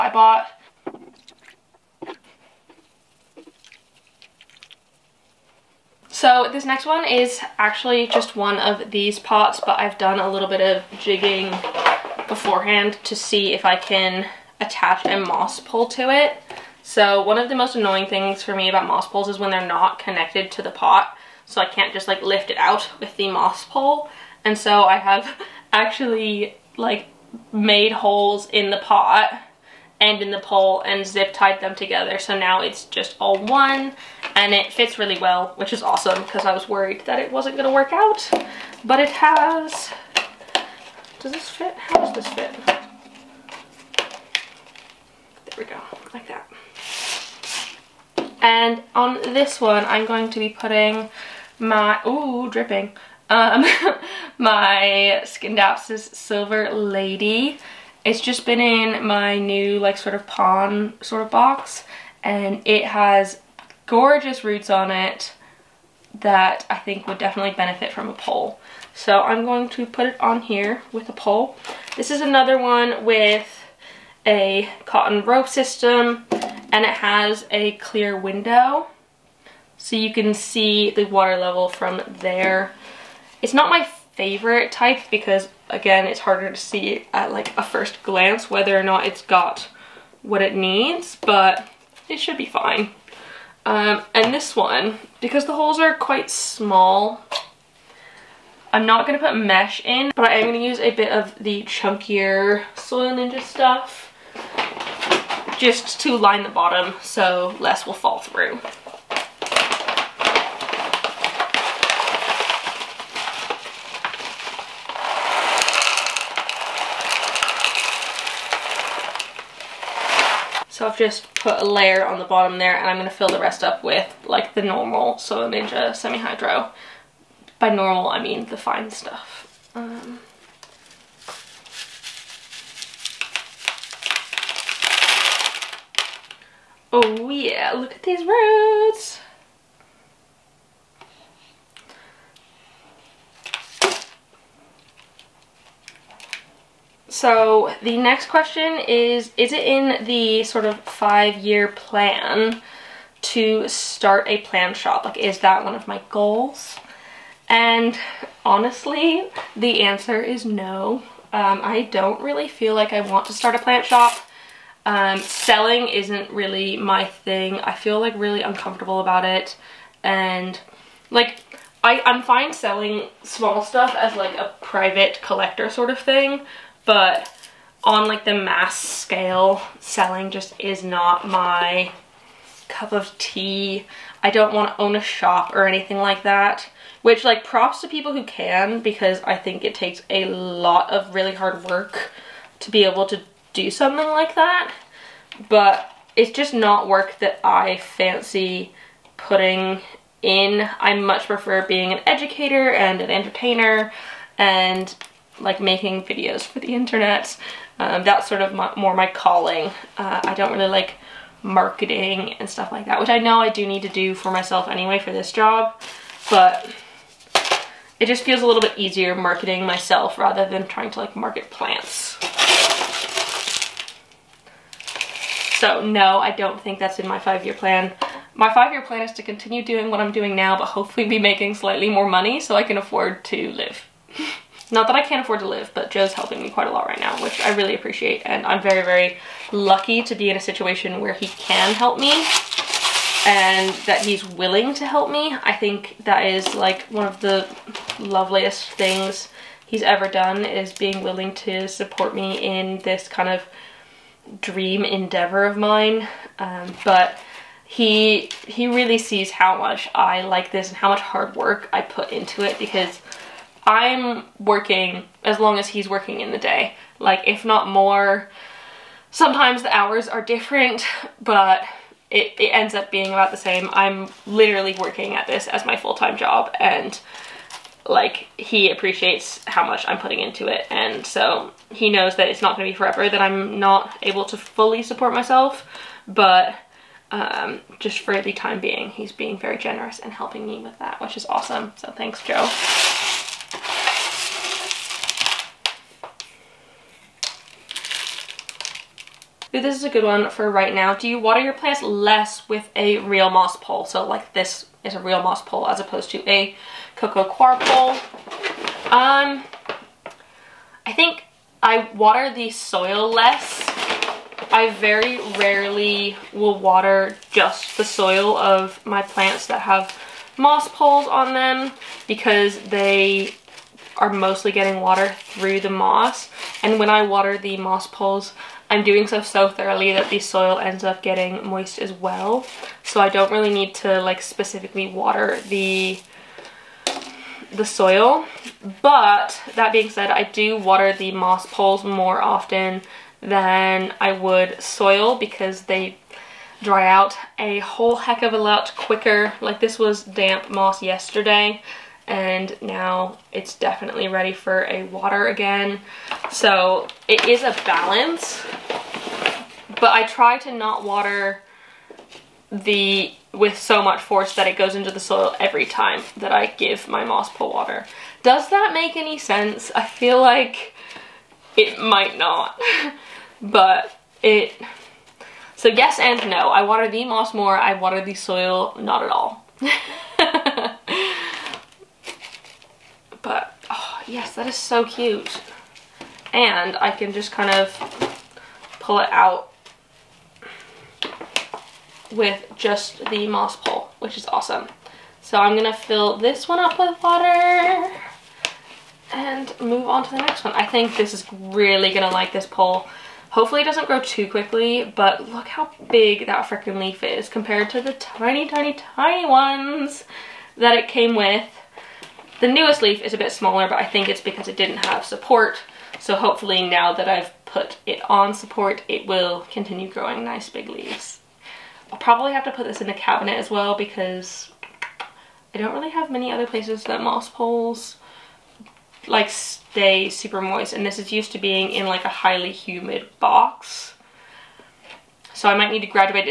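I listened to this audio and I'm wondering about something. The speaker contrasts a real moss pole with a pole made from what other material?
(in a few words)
Cocoa coir.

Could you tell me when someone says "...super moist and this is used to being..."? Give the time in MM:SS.
07:10.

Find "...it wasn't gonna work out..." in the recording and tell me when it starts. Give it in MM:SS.
00:37.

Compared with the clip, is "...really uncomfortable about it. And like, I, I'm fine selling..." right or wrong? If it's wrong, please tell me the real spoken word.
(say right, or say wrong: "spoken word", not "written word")
right.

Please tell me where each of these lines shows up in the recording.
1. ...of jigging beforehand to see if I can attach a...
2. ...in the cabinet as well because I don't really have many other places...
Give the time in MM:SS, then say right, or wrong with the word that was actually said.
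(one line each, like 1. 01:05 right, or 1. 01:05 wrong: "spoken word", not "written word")
1. 00:10 right
2. 07:02 right.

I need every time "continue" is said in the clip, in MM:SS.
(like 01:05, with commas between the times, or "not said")
03:49, 06:59.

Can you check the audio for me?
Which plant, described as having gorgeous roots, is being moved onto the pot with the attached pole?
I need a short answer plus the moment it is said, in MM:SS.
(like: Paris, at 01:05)
Scindapsus Silver Lady, at 00:55.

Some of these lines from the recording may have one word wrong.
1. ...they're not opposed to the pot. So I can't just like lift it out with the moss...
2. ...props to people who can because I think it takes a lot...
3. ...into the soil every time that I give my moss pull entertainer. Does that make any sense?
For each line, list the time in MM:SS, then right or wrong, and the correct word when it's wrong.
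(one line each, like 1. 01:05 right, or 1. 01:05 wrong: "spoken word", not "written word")
1. 00:19 wrong: "connected", not "opposed"
2. 03:07 right
3. 06:04 wrong: "water", not "entertainer".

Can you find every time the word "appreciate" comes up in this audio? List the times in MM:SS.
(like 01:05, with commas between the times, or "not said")
03:57, 04:38.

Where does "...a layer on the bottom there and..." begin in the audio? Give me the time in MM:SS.
02:01.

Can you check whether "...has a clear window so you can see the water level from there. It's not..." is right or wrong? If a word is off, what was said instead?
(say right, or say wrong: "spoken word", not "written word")
right.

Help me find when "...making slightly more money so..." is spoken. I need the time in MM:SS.
03:51.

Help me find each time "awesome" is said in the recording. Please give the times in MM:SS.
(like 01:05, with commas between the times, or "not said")
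00:35, 04:51, 06:34.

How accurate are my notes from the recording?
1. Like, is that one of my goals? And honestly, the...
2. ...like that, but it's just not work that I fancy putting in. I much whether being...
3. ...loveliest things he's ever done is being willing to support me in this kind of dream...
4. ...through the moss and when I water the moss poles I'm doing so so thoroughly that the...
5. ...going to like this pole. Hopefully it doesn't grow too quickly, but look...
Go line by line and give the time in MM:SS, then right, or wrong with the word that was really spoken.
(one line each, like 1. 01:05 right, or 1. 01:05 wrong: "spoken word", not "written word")
1. 02:35 right
2. 03:14 wrong: "prefer", not "whether"
3. 04:08 right
4. 05:25 right
5. 06:41 right.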